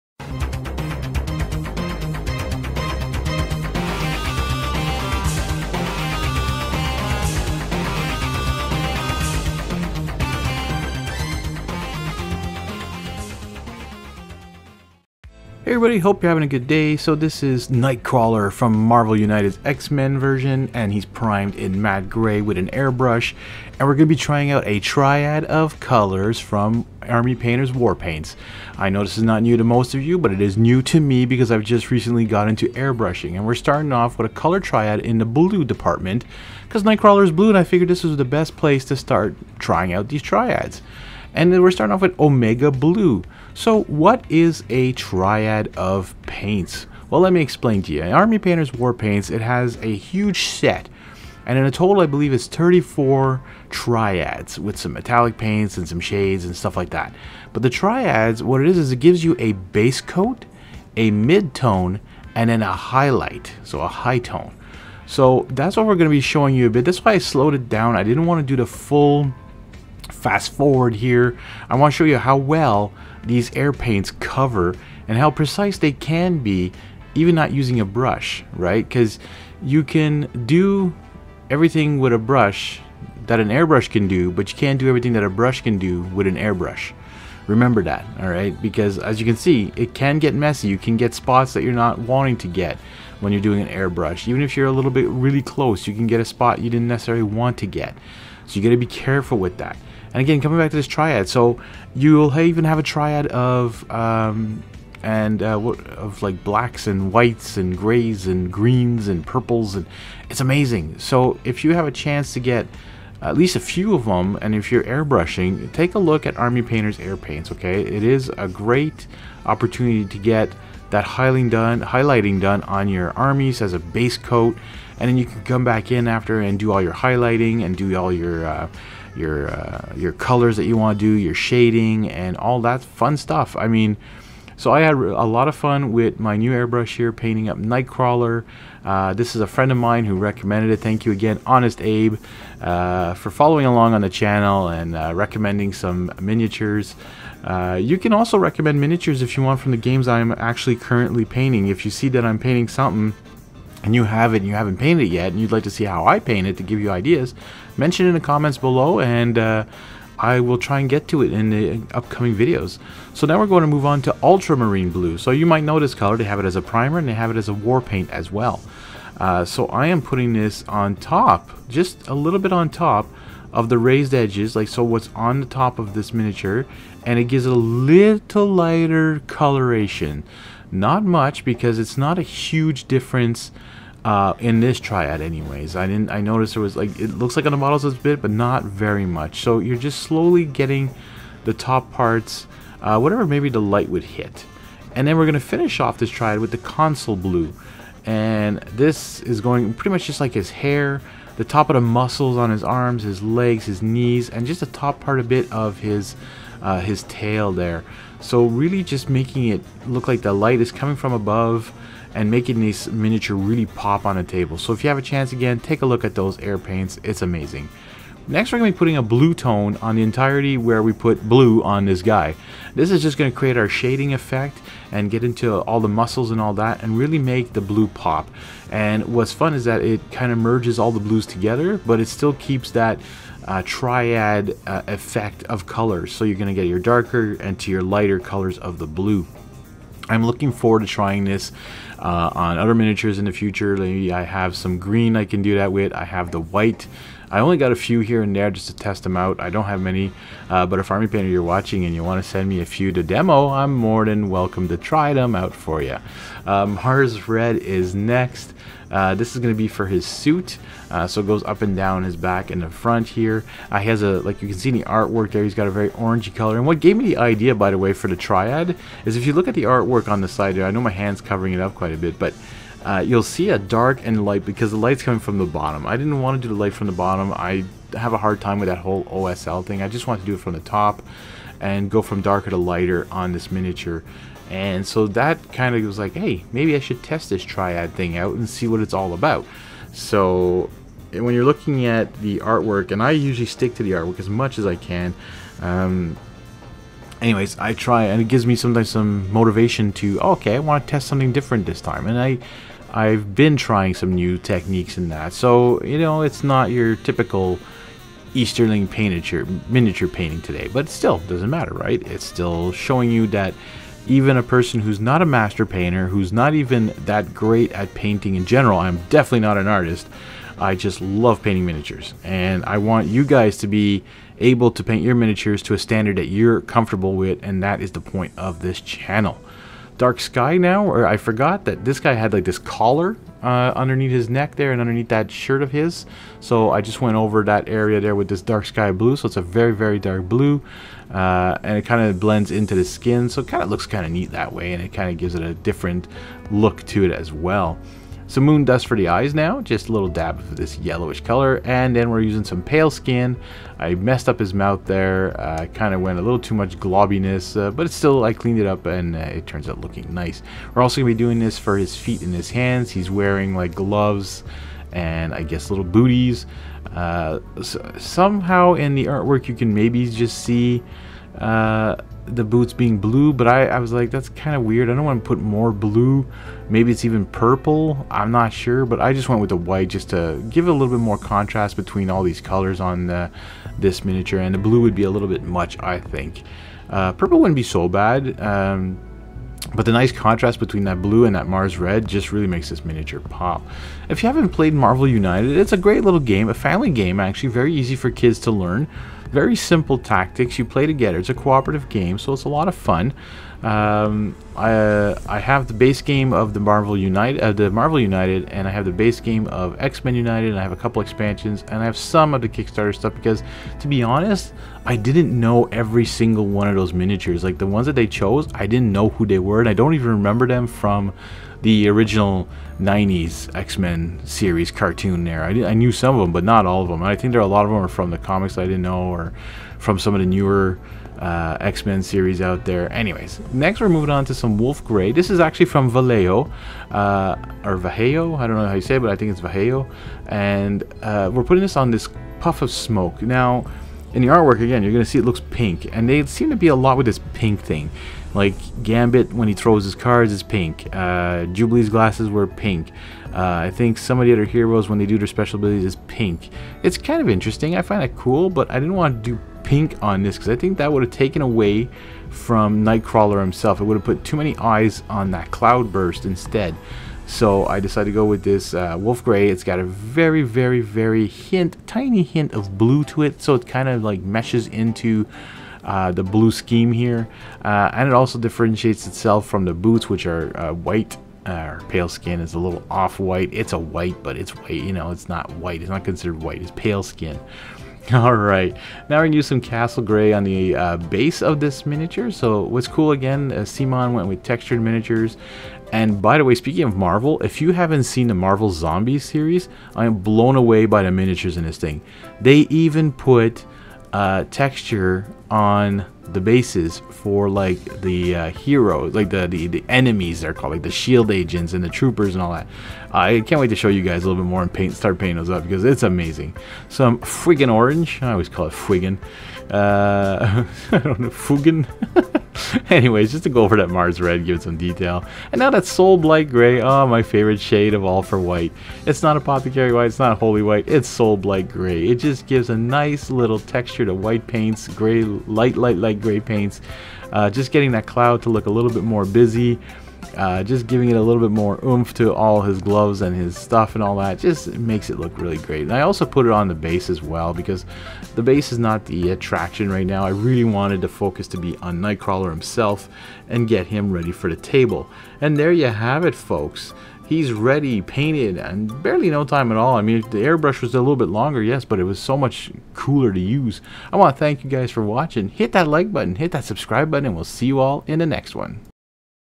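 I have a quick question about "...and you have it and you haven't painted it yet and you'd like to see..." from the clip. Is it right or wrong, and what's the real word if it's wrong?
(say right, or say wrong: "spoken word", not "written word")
right.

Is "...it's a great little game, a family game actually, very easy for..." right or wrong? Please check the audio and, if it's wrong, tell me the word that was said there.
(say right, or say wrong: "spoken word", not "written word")
right.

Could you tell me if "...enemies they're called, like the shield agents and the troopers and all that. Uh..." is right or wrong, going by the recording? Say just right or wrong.
right.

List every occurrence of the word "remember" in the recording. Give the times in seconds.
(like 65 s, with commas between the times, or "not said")
87 s, 420 s.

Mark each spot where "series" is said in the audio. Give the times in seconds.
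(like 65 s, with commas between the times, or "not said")
424 s, 432 s, 499 s.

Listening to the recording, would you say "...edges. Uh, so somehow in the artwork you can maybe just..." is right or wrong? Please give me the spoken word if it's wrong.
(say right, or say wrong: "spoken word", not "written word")
wrong: "booties", not "edges".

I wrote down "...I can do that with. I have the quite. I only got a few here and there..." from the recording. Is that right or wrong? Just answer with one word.
wrong.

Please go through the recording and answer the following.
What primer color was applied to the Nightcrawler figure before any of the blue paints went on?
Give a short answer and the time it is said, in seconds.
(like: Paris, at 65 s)
Matte gray, at 21 s.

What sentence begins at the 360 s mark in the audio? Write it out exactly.
We're also going to be doing this for his feet and his hands.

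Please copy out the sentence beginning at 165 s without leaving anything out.
So you might know this color, they have it as a primer and they have it as a war paint as well.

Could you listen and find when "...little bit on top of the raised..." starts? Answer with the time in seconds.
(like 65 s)
172 s.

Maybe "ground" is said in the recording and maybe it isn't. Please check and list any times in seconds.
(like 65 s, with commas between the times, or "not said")
not said.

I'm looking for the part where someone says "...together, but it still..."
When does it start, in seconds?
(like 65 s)
231 s.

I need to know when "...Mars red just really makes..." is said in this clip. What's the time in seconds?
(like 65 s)
391 s.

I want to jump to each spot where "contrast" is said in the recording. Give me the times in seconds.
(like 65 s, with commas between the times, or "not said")
381 s, 390 s.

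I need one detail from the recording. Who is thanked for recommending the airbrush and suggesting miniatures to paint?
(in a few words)
Honest Abe.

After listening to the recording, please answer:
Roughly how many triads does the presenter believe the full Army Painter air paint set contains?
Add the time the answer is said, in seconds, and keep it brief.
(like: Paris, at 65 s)
34, at 52 s.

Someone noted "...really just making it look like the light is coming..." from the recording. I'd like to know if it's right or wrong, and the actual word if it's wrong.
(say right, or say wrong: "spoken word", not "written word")
right.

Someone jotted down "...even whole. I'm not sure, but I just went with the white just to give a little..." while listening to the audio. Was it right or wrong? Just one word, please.
wrong.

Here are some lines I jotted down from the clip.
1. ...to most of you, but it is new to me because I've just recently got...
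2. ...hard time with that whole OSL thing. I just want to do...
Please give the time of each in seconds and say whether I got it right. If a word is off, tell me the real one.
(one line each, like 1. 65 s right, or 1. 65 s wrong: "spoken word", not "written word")
1. 29 s right
2. 278 s right.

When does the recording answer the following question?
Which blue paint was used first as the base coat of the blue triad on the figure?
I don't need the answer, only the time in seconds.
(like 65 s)
42 s.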